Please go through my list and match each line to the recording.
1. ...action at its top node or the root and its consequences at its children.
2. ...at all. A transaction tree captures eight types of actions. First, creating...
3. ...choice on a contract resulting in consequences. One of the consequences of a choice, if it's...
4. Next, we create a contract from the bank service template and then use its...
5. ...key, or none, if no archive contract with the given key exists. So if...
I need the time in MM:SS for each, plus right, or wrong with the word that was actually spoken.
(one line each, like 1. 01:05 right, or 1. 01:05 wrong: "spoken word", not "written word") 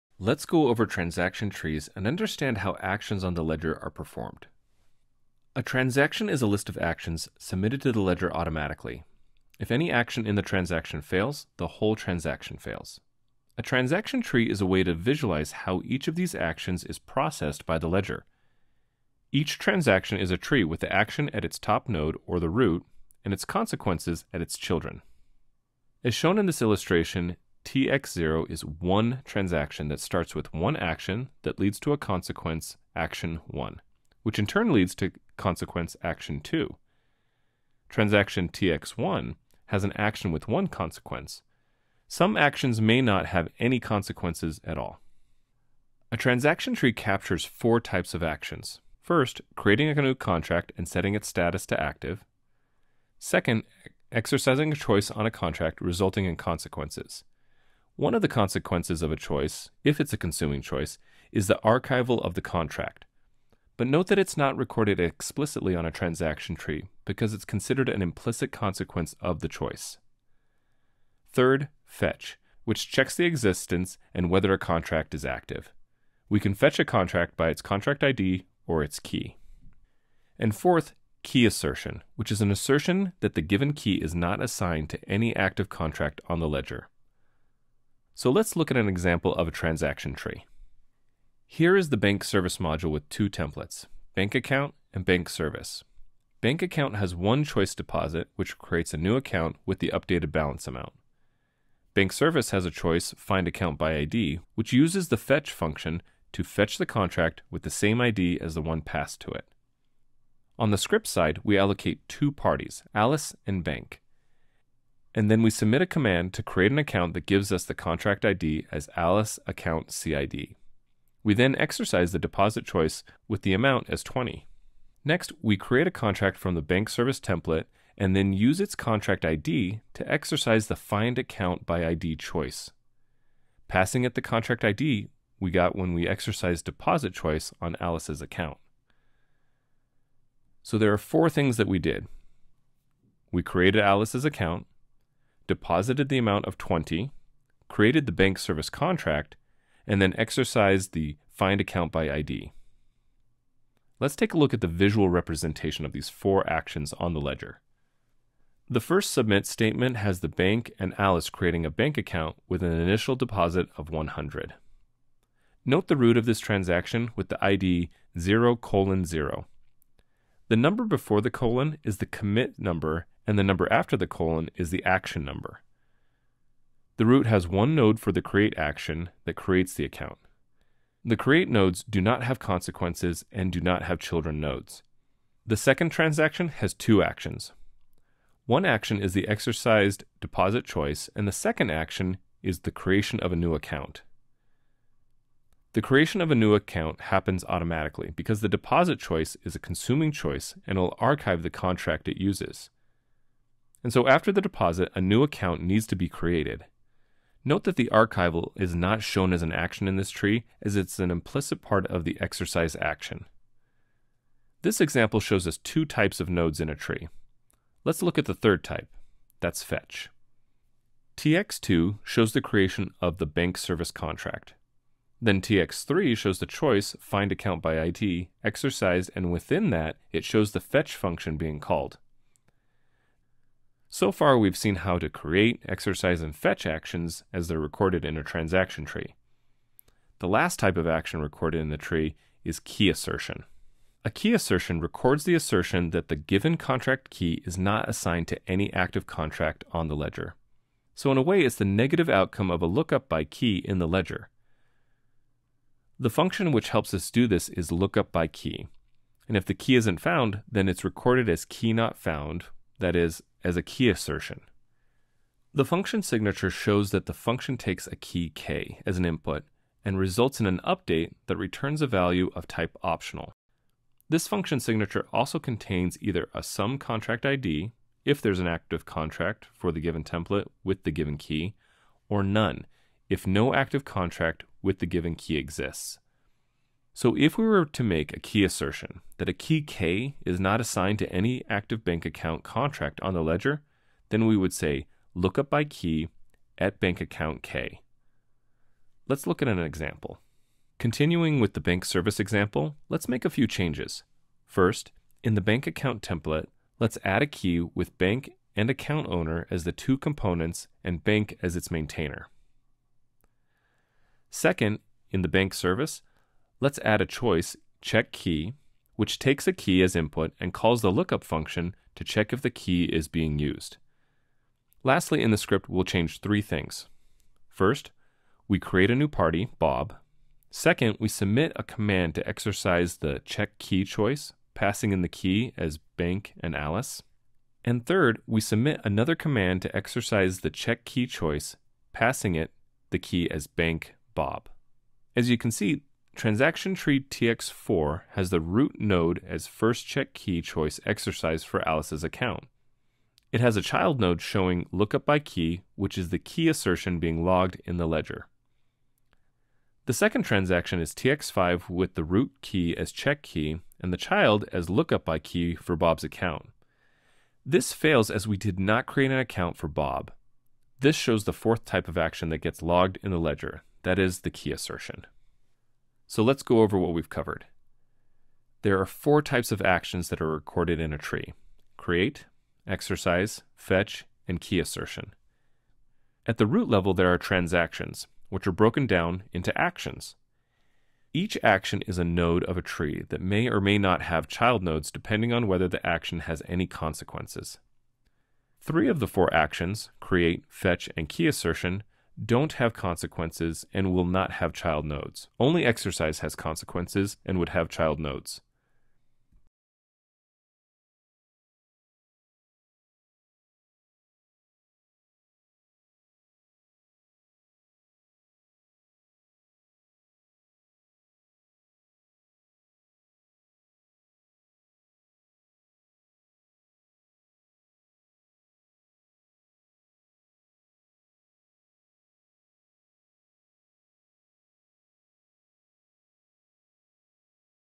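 1. 00:20 right
2. 00:44 wrong: "four", not "eight"
3. 00:54 right
4. 02:05 right
5. 04:41 wrong: "active", not "archive".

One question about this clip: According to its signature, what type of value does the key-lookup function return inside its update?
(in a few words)
optional.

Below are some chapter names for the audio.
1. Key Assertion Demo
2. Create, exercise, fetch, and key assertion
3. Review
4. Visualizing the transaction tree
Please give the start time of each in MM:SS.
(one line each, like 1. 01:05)
1. 03:53
2. 00:48
3. 06:15
4. 02:33.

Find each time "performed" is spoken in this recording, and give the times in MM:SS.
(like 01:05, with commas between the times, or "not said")
00:03.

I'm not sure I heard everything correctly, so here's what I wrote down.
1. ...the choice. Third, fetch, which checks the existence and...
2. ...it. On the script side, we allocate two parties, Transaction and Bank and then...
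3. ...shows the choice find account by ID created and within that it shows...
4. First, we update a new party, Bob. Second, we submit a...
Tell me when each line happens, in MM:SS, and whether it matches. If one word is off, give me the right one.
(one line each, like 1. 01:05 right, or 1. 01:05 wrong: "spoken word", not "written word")
1. 01:09 right
2. 01:49 wrong: "Alice", not "Transaction"
3. 03:46 wrong: "exercised", not "created"
4. 05:27 wrong: "create", not "update".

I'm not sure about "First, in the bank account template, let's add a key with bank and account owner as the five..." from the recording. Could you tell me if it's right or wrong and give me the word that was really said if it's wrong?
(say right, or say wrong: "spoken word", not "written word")
wrong: "two", not "five".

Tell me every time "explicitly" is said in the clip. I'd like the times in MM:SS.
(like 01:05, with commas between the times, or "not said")
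01:04.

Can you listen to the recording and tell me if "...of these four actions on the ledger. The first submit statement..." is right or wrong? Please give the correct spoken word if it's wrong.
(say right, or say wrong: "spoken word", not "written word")
right.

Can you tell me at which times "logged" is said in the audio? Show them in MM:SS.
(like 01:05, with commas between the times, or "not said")
05:57, 06:12.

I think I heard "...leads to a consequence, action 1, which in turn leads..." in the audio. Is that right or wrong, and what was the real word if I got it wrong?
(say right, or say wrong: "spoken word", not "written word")
right.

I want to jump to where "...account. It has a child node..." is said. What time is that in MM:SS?
05:52.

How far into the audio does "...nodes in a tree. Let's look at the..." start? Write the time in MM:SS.
03:36.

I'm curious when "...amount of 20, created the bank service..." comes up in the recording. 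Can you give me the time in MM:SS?
02:26.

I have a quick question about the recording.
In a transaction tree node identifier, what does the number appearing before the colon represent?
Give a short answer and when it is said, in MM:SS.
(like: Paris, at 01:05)
commit number, at 02:52.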